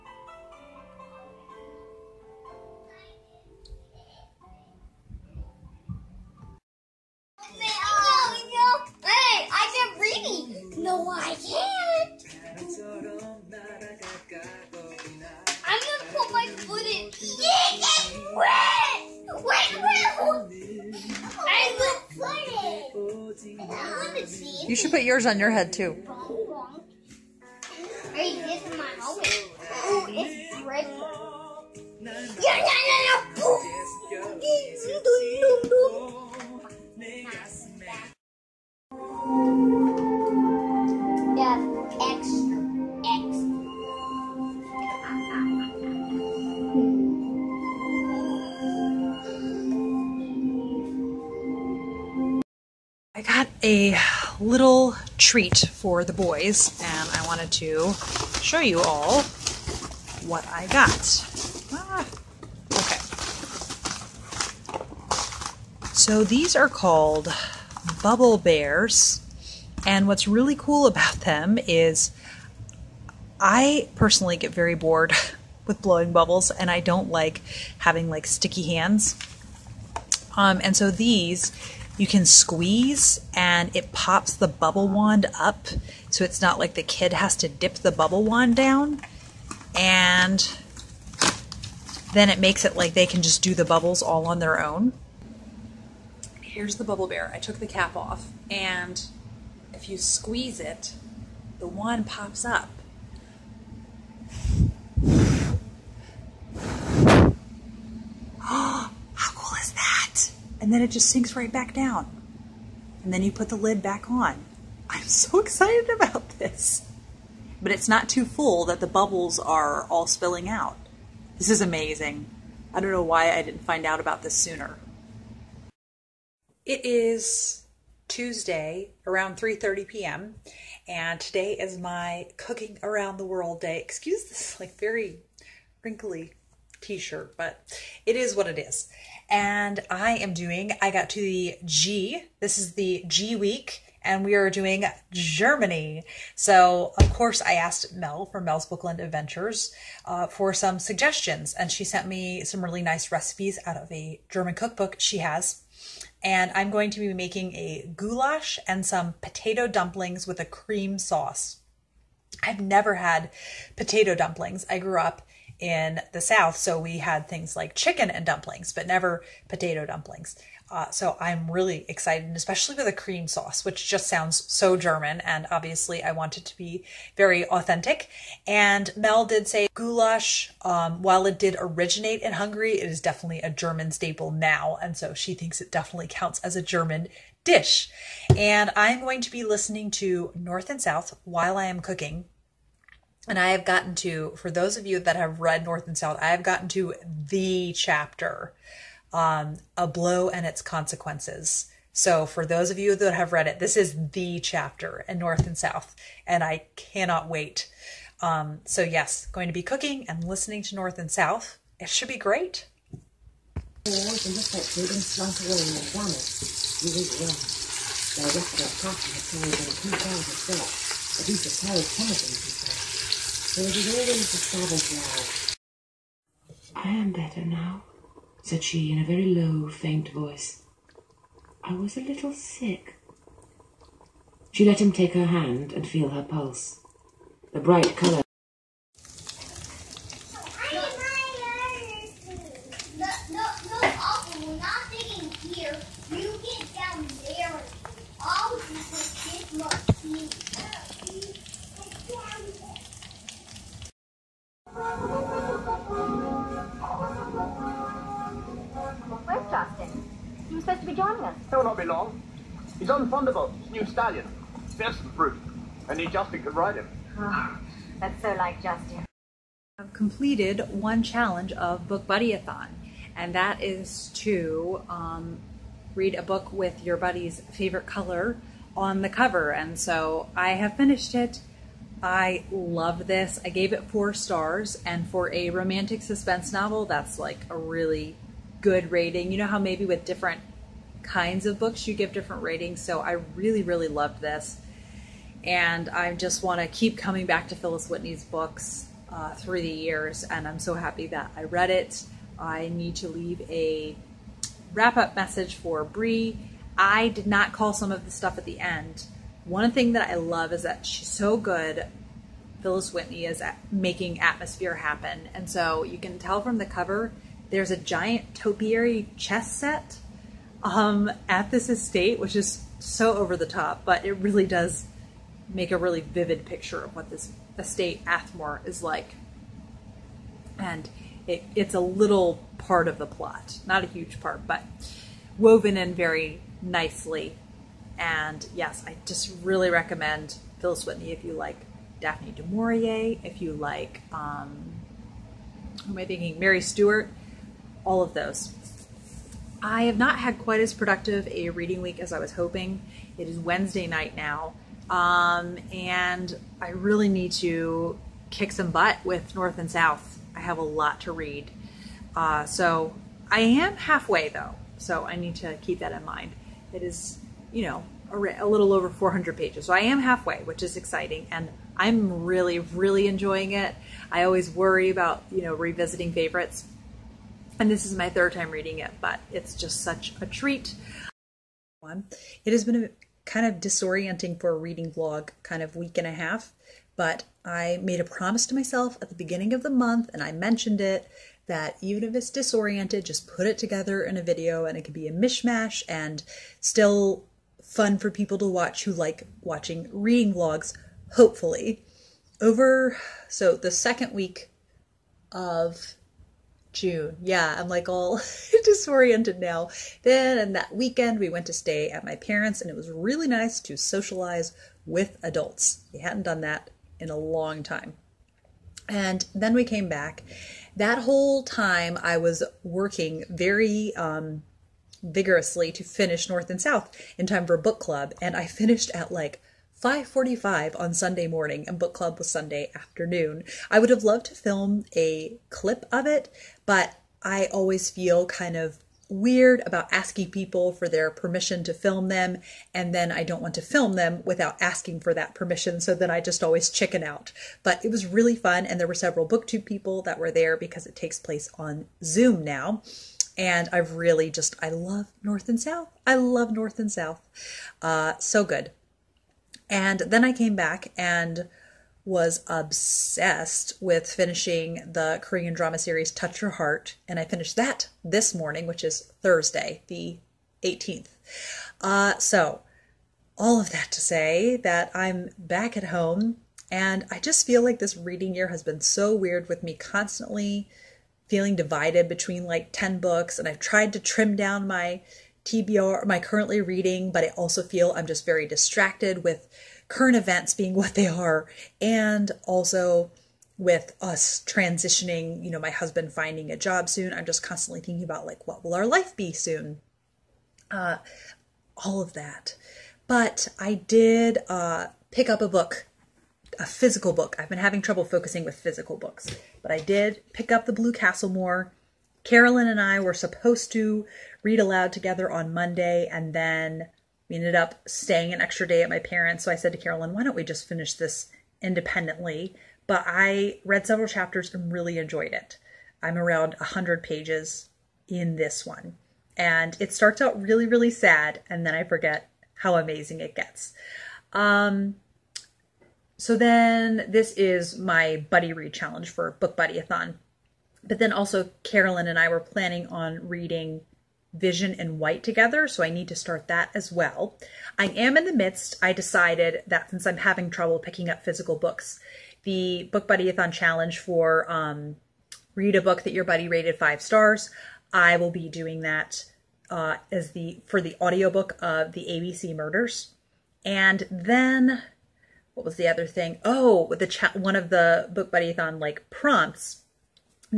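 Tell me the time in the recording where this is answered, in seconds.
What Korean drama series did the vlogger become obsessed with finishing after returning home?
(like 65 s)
466 s.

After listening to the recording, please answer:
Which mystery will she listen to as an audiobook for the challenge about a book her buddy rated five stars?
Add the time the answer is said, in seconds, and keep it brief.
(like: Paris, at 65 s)
The ABC Murders, at 562 s.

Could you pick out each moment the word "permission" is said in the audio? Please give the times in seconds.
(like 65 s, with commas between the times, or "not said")
441 s, 445 s.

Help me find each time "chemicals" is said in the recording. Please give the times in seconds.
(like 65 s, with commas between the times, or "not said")
not said.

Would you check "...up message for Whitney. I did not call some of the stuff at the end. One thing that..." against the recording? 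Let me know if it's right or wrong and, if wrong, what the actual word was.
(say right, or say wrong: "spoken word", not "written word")
wrong: "Brie", not "Whitney".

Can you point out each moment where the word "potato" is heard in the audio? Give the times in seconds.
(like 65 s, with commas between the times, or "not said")
159 s, 163 s, 169 s.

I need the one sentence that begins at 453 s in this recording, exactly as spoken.
And I've really just, I love North and South.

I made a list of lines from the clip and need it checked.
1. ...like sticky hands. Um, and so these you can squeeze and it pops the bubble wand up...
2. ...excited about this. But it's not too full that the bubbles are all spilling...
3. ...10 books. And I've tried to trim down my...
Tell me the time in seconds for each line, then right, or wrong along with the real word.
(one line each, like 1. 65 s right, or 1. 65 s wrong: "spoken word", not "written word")
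1. 78 s right
2. 115 s right
3. 482 s right.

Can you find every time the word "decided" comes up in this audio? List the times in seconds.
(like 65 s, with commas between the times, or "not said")
548 s.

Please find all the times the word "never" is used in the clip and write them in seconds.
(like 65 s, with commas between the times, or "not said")
162 s, 168 s.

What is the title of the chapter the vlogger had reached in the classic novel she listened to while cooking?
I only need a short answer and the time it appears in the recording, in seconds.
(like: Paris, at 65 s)
A Blow and Its Consequences, at 199 s.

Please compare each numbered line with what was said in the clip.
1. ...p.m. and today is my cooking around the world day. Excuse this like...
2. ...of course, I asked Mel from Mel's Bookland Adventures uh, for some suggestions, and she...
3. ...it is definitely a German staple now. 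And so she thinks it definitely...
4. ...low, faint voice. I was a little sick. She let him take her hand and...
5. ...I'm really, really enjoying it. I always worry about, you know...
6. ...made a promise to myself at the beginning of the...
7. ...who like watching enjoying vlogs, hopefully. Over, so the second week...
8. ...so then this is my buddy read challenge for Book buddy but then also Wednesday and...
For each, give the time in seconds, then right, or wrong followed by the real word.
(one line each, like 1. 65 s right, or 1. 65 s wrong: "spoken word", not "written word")
1. 129 s right
2. 146 s right
3. 182 s right
4. 229 s right
5. 371 s right
6. 387 s right
7. 398 s wrong: "reading", not "enjoying"
8. 536 s wrong: "Carolyn", not "Wednesday".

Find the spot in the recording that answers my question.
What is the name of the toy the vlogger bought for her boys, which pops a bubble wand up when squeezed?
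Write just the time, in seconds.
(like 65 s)
68 s.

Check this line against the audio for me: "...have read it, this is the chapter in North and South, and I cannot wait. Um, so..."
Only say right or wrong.
right.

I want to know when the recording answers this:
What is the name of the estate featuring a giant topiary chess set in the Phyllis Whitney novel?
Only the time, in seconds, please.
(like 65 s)
328 s.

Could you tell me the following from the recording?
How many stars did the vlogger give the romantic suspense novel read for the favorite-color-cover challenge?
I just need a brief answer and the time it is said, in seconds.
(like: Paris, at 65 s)
4, at 283 s.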